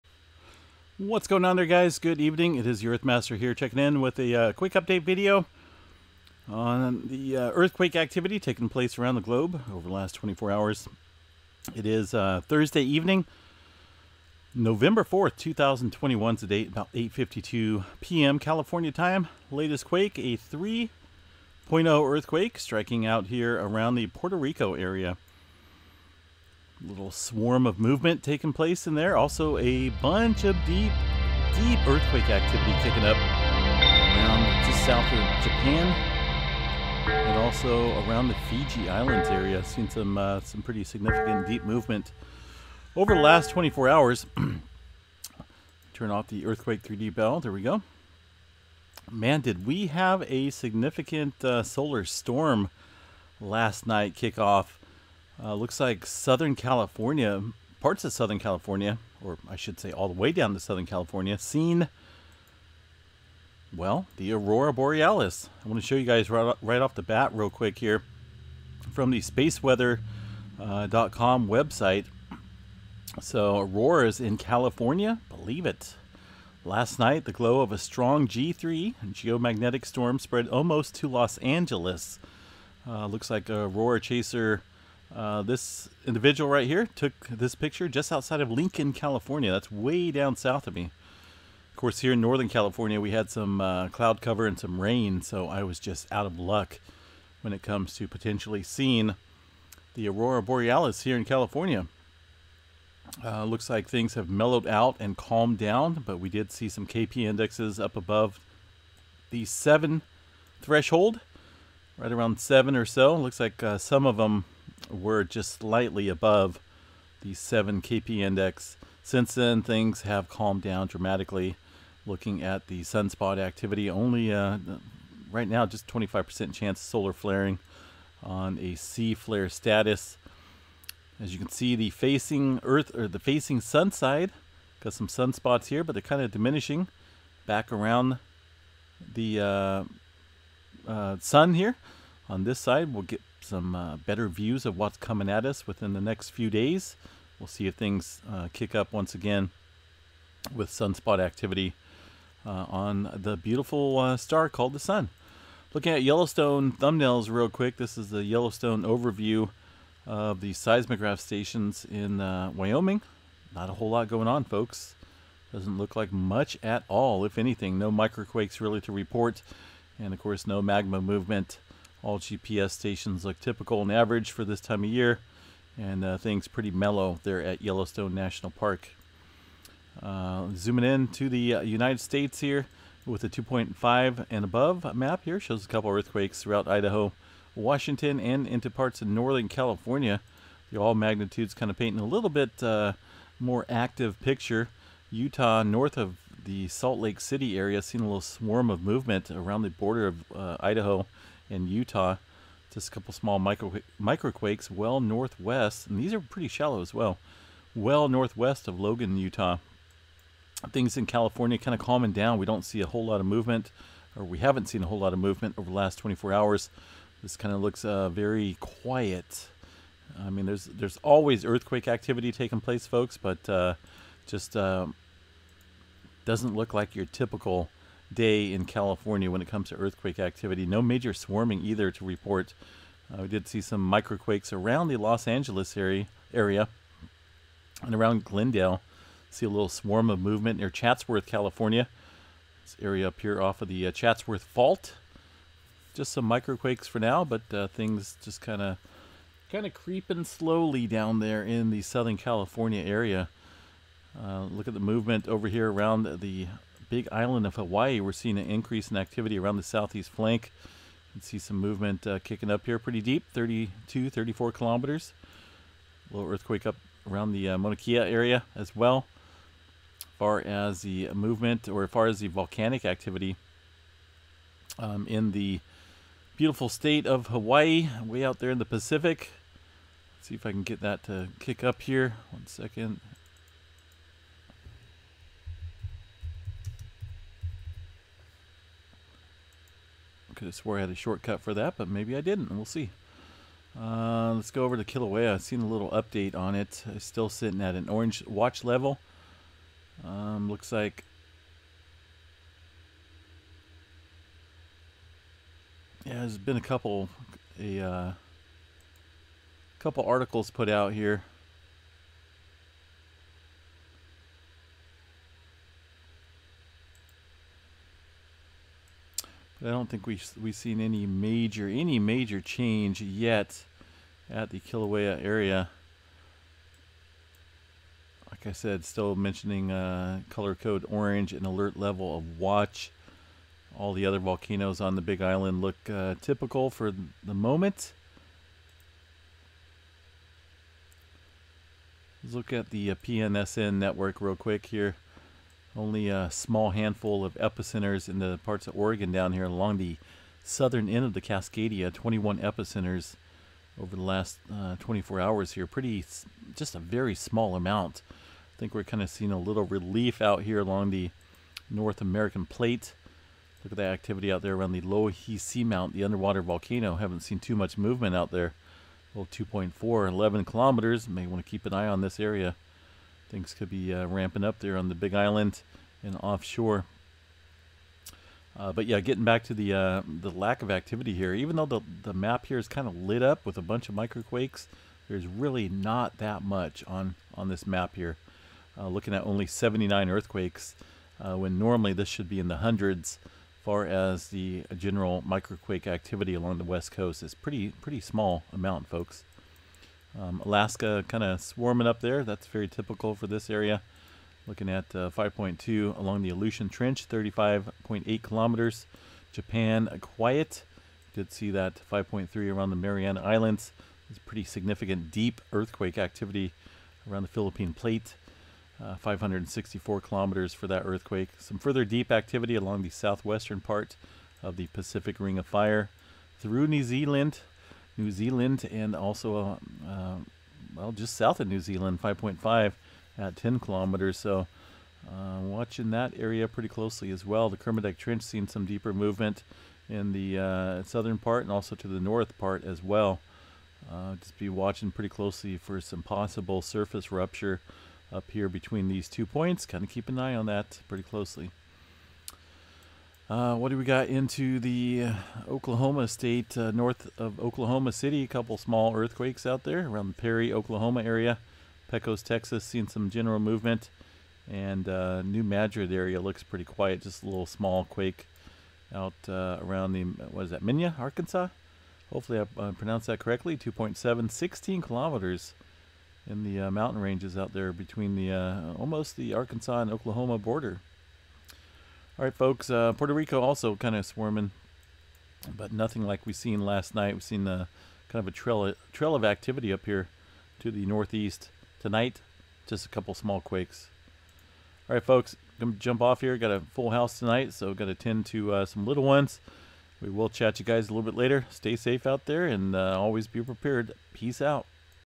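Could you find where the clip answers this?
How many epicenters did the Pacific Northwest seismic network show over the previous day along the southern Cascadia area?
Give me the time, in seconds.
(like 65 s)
351 s.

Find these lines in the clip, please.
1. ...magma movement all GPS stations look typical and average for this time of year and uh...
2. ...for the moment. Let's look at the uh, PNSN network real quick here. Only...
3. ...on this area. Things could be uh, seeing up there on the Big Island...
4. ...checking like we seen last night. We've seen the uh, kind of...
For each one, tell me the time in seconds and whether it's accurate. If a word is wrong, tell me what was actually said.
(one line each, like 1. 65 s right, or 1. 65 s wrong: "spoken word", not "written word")
1. 170 s right
2. 336 s right
3. 371 s wrong: "ramping", not "seeing"
4. 485 s wrong: "nothing", not "checking".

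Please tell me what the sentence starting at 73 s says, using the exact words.
So auroras in California, believe it.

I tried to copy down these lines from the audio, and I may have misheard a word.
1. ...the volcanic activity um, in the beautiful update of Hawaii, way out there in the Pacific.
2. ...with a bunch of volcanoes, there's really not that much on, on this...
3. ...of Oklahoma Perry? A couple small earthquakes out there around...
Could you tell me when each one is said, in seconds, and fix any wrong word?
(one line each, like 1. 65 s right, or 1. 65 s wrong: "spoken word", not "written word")
1. 272 s wrong: "state", not "update"
2. 383 s wrong: "microquakes", not "volcanoes"
3. 457 s wrong: "City", not "Perry".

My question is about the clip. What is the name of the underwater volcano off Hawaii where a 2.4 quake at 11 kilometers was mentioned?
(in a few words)
Loihi Seamount.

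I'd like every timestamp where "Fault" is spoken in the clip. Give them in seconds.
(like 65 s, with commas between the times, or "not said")
244 s.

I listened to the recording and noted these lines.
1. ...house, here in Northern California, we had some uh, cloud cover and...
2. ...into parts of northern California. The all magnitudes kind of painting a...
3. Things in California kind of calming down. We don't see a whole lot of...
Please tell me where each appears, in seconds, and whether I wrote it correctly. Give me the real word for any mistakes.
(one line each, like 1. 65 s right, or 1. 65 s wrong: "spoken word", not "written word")
1. 91 s wrong: "course", not "house"
2. 188 s right
3. 210 s right.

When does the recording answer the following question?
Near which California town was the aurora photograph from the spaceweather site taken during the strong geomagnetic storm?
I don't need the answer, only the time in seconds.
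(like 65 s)
88 s.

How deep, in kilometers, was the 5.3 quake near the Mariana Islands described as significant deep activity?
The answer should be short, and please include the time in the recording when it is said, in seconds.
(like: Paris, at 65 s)
564, at 418 s.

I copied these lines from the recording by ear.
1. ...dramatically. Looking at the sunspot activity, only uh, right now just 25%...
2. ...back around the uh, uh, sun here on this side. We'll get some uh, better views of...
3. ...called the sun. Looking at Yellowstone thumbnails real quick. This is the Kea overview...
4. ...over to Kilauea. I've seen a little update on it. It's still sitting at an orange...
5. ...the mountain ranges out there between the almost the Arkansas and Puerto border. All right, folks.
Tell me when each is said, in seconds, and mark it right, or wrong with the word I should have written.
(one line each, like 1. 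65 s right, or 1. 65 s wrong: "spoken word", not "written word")
1. 120 s right
2. 137 s right
3. 154 s wrong: "Yellowstone", not "Kea"
4. 294 s right
5. 476 s wrong: "Oklahoma", not "Puerto".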